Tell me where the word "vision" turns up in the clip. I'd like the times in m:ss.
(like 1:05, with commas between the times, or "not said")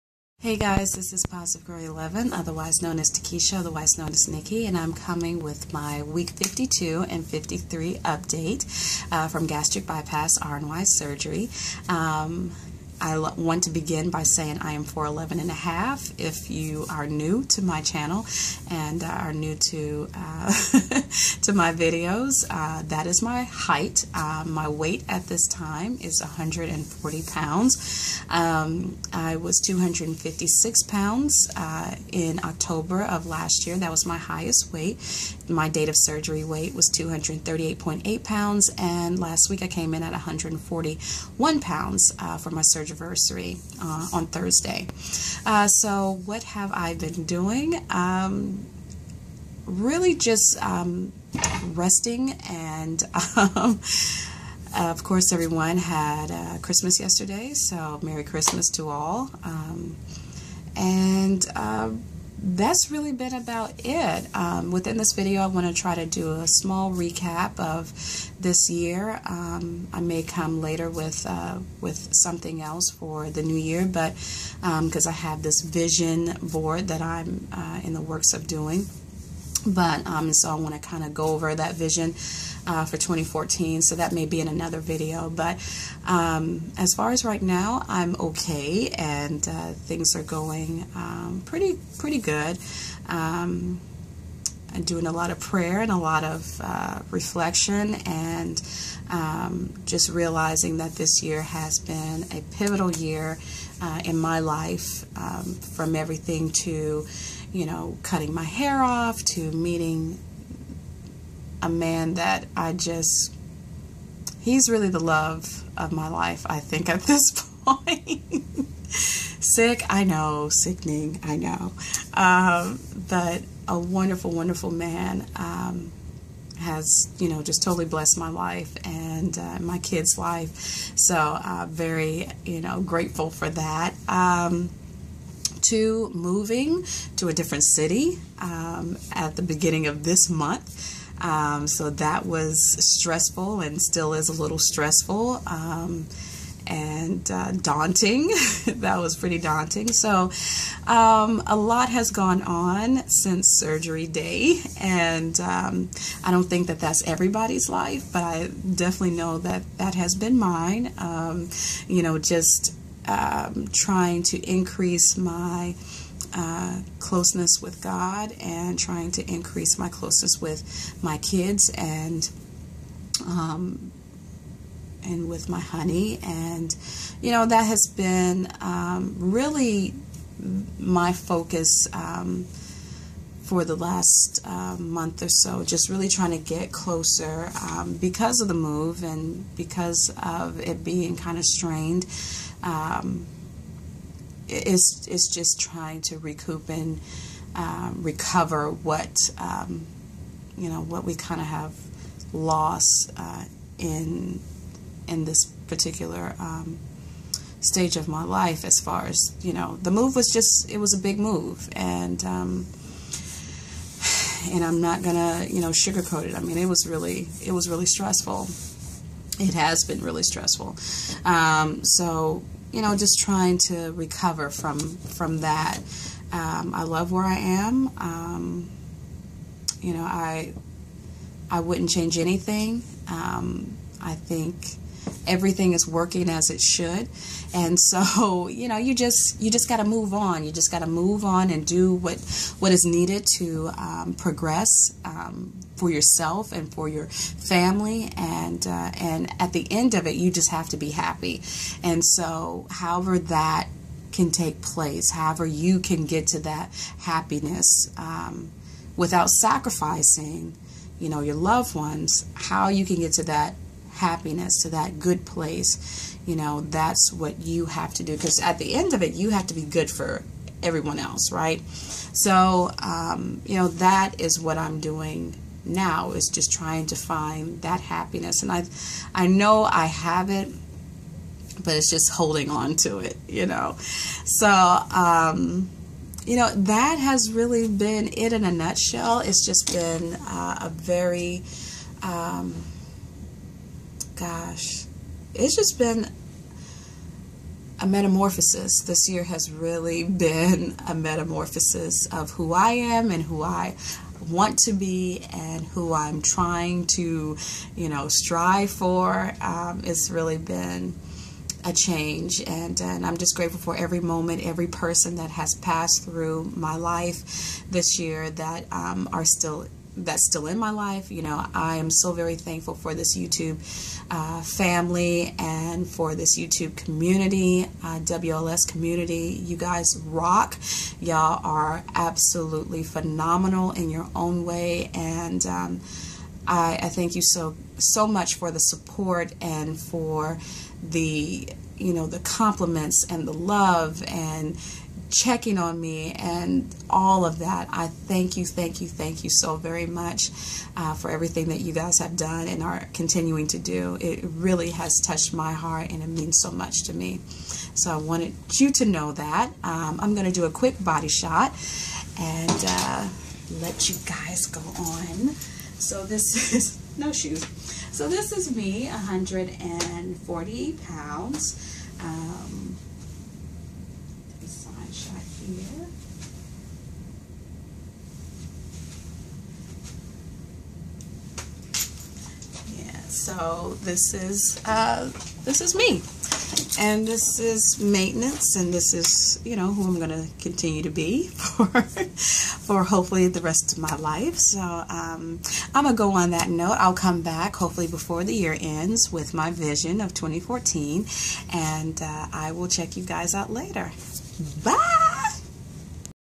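1:15, 1:21, 6:39.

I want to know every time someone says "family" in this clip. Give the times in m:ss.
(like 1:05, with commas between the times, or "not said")
4:07, 5:24.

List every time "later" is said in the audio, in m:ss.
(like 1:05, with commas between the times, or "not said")
1:10, 6:43.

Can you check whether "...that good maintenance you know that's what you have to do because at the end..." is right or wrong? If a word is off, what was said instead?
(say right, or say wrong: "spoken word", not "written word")
wrong: "place", not "maintenance".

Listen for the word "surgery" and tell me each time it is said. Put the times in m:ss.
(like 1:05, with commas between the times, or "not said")
0:10, 0:35, 0:42, 2:33.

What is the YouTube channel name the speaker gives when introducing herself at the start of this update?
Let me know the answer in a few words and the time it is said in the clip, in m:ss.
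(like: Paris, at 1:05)
Positive Girl 11, at 0:01.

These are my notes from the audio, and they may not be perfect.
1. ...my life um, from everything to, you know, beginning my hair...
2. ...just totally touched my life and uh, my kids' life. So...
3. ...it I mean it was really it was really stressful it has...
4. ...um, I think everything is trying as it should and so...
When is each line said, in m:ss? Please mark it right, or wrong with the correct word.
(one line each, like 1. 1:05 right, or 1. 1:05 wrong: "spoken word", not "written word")
1. 1:44 wrong: "cutting", not "beginning"
2. 2:07 wrong: "blessed", not "touched"
3. 3:36 right
4. 3:53 wrong: "working", not "trying".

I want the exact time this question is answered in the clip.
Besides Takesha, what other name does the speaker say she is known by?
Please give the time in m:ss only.
0:04.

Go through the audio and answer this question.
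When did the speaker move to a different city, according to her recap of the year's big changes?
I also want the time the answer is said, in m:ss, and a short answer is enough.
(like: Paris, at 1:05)
Beginning of this month, at 2:19.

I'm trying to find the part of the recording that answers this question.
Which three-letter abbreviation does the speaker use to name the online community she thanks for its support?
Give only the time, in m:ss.
5:27.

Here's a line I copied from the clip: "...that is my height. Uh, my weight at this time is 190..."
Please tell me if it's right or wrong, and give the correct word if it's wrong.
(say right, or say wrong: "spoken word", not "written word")
wrong: "140", not "190".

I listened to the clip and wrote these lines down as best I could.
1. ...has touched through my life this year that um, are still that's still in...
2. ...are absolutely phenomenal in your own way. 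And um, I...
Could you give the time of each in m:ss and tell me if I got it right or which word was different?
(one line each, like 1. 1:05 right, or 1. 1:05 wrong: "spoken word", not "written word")
1. 5:15 wrong: "passed", not "touched"
2. 5:31 right.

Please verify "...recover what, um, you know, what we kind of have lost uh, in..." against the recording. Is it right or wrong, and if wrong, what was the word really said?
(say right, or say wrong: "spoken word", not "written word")
right.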